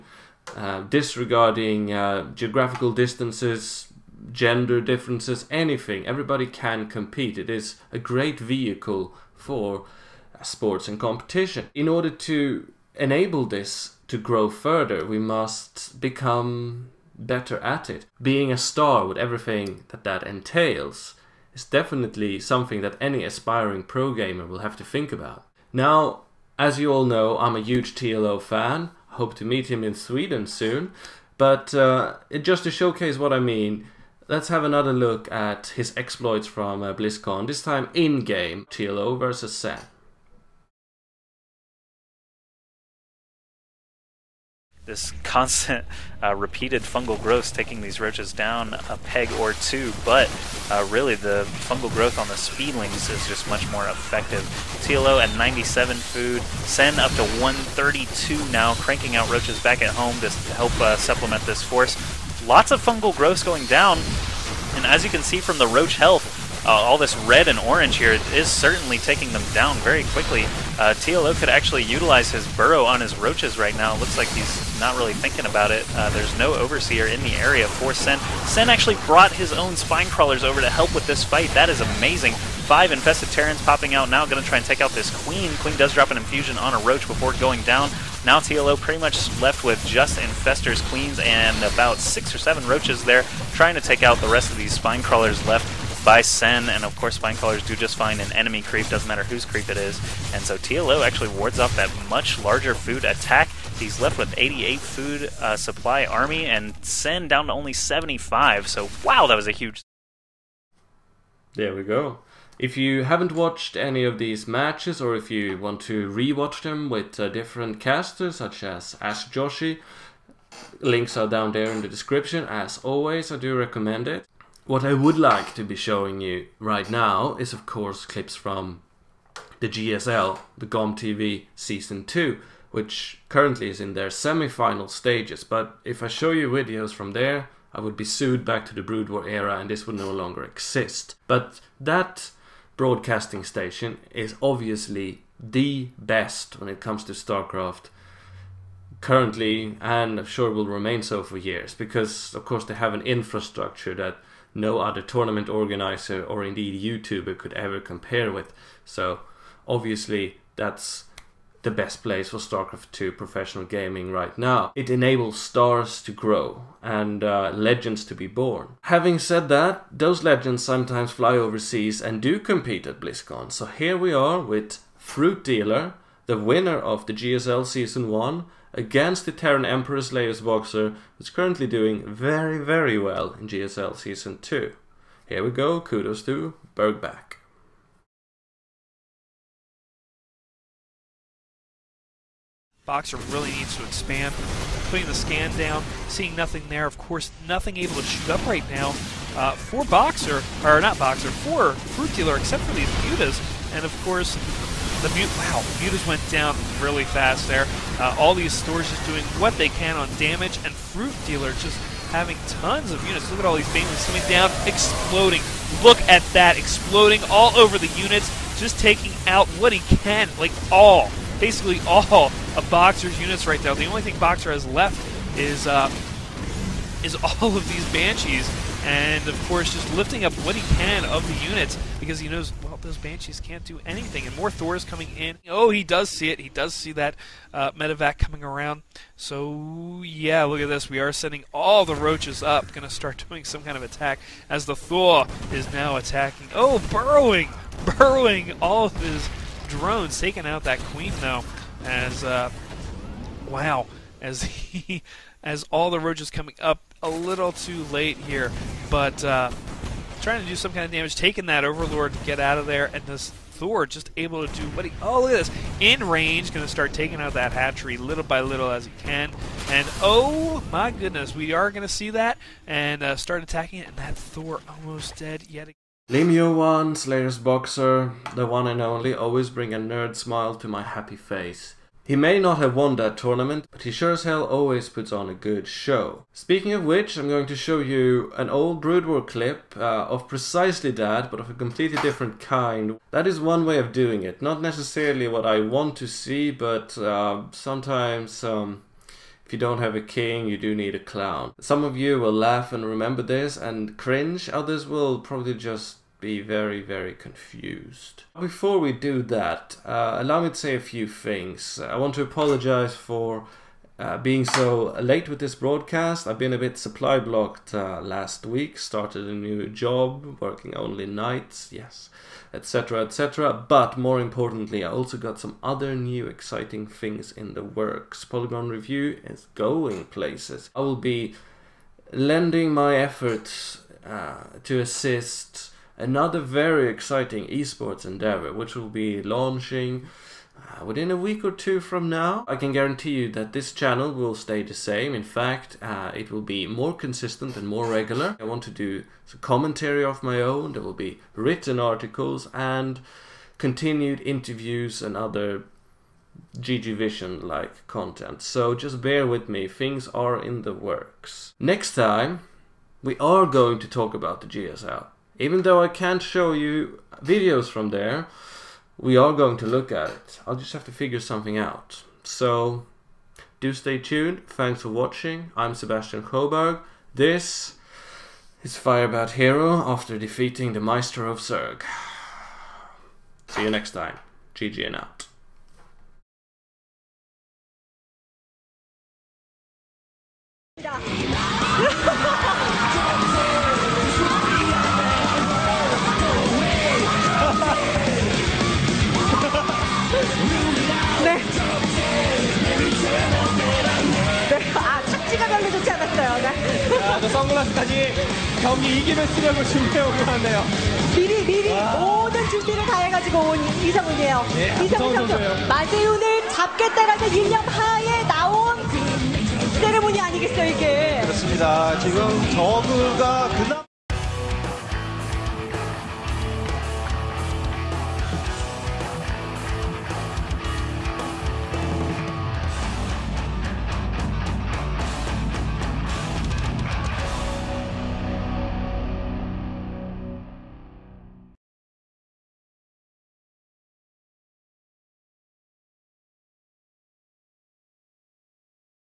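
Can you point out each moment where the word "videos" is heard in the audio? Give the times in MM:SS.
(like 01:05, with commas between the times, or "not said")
02:16, 06:07.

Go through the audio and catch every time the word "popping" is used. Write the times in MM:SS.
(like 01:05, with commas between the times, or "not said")
01:23.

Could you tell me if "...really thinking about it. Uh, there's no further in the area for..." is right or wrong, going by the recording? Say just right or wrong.
wrong.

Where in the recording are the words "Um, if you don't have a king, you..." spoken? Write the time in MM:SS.
04:58.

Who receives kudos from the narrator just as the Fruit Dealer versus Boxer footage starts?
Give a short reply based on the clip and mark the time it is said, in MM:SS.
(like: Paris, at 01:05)
Burgback, at 03:05.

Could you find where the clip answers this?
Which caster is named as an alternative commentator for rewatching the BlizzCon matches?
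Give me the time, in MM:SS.
01:59.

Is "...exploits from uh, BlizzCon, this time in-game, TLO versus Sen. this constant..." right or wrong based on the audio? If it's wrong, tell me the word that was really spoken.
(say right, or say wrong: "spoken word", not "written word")
right.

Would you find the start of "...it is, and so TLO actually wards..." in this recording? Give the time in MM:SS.
01:39.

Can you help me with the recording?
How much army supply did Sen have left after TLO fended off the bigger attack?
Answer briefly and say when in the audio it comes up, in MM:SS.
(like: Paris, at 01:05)
75, at 01:46.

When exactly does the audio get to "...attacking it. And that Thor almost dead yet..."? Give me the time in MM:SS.
04:33.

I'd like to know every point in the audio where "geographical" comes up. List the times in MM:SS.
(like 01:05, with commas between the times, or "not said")
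00:02.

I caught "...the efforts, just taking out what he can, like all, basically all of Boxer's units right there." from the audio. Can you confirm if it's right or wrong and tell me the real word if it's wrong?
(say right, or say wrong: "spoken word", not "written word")
wrong: "units", not "efforts".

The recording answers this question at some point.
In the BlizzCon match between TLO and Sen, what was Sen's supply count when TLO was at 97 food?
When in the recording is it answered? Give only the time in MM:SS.
00:56.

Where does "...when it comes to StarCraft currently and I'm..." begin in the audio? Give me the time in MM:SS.
02:26.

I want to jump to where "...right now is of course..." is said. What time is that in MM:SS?
02:06.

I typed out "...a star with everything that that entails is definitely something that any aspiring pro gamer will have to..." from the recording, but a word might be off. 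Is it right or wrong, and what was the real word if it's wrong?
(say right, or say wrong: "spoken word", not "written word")
right.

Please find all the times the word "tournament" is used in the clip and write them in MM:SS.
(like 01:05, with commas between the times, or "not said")
02:35, 04:43.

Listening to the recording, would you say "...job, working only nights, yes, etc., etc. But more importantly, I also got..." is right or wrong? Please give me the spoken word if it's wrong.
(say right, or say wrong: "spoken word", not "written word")
right.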